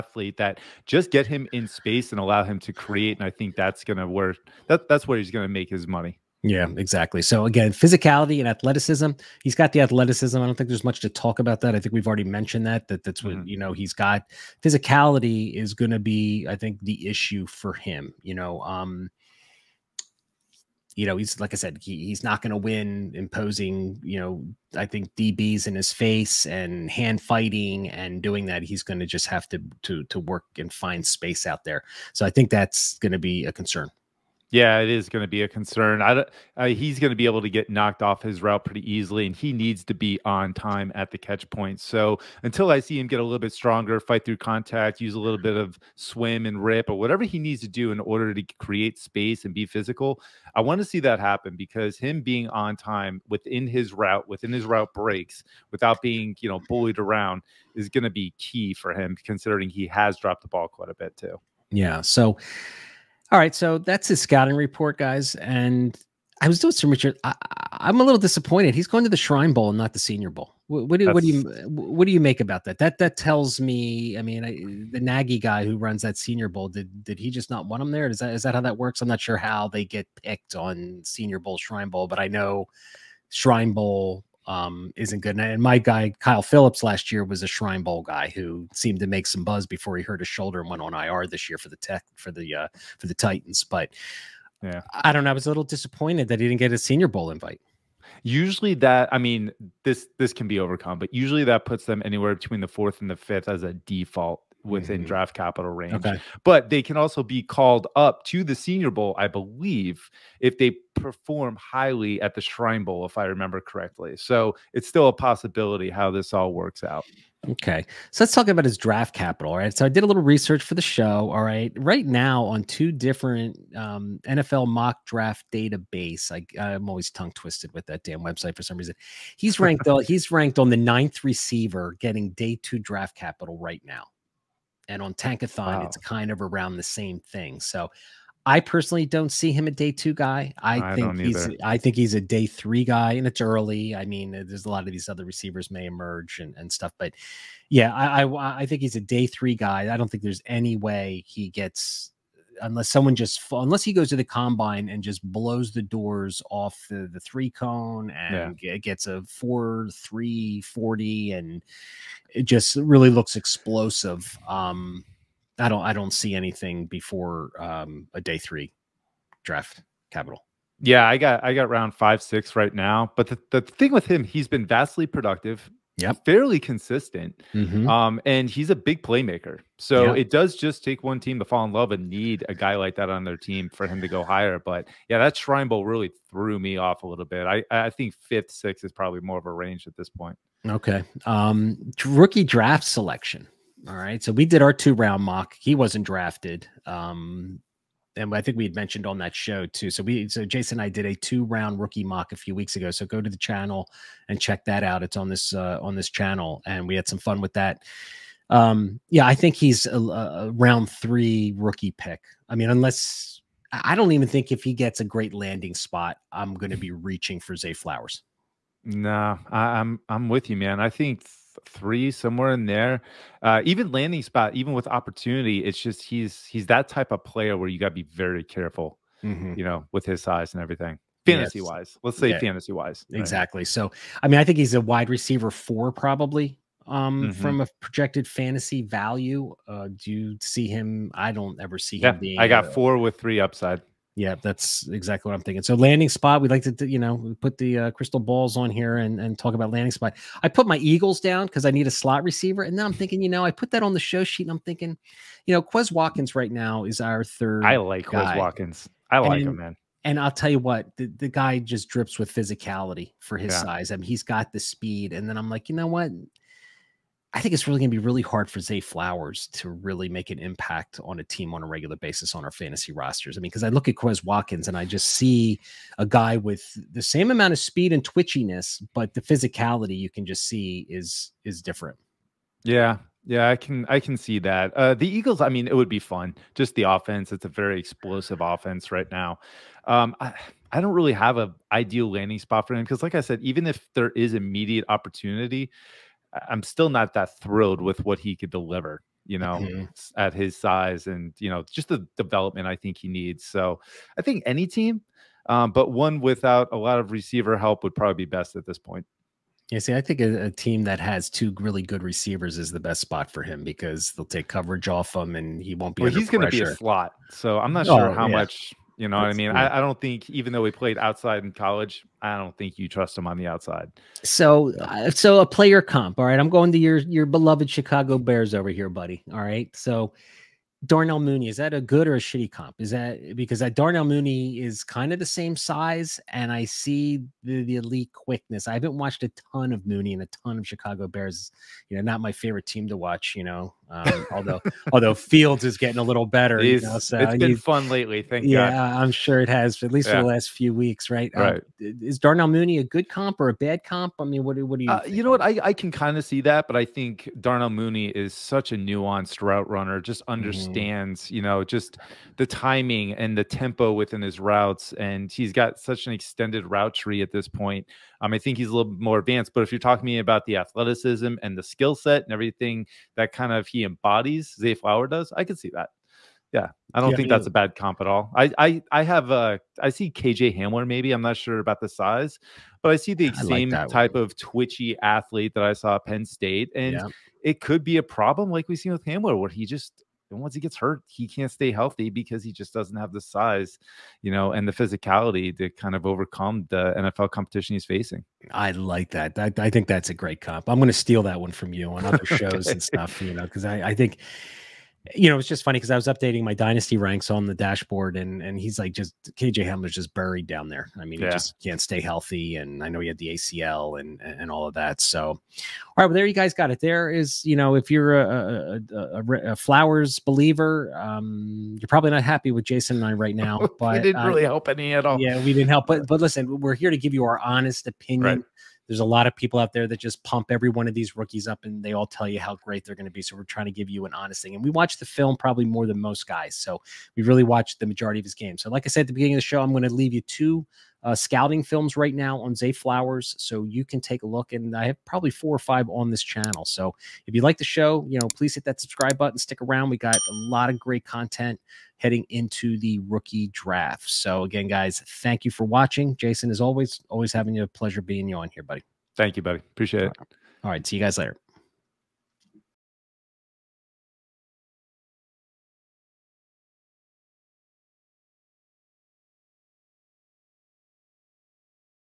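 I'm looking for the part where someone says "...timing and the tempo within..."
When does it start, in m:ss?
6:02.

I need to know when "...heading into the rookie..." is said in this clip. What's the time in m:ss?
7:31.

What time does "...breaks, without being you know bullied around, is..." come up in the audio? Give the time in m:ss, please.
0:54.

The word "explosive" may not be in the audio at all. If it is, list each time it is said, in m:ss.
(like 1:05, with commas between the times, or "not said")
2:43, 4:47.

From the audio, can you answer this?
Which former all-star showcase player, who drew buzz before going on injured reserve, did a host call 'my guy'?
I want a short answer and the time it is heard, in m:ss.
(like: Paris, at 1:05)
Kyle Philips, at 1:26.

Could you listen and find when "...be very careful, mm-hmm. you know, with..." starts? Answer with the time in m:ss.
3:47.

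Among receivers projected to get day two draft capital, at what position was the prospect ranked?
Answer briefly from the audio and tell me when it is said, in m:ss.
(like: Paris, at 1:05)
9th, at 2:10.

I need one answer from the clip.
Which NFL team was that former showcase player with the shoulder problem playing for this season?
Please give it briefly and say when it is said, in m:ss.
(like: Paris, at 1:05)
Titans, at 1:33.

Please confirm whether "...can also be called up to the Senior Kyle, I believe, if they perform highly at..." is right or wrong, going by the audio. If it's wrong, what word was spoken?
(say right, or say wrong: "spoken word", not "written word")
wrong: "Bowl", not "Kyle".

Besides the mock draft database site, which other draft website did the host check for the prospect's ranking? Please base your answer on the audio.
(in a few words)
Tankathon.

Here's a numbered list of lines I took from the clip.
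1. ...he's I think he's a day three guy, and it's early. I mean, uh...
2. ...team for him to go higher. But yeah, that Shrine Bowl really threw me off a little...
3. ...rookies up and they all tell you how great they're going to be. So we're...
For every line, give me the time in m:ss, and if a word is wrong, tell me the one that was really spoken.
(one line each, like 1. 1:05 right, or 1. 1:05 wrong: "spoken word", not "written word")
1. 2:21 right
2. 3:03 right
3. 7:11 right.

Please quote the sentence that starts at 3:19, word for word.
So we, so Jason and I did a two round rookie mock a few weeks ago.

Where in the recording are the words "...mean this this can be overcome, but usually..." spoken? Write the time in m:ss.
1:39.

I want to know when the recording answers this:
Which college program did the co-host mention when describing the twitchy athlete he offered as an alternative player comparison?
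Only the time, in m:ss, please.
6:26.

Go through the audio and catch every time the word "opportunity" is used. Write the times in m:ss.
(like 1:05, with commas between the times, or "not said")
3:44, 4:54.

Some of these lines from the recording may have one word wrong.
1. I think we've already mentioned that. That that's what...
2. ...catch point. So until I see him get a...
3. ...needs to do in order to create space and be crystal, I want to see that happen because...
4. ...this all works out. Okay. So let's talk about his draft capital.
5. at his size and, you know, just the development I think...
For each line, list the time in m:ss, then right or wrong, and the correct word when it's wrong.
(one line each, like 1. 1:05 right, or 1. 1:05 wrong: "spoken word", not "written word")
1. 0:11 right
2. 0:41 right
3. 0:47 wrong: "physical", not "crystal"
4. 1:56 right
5. 5:00 right.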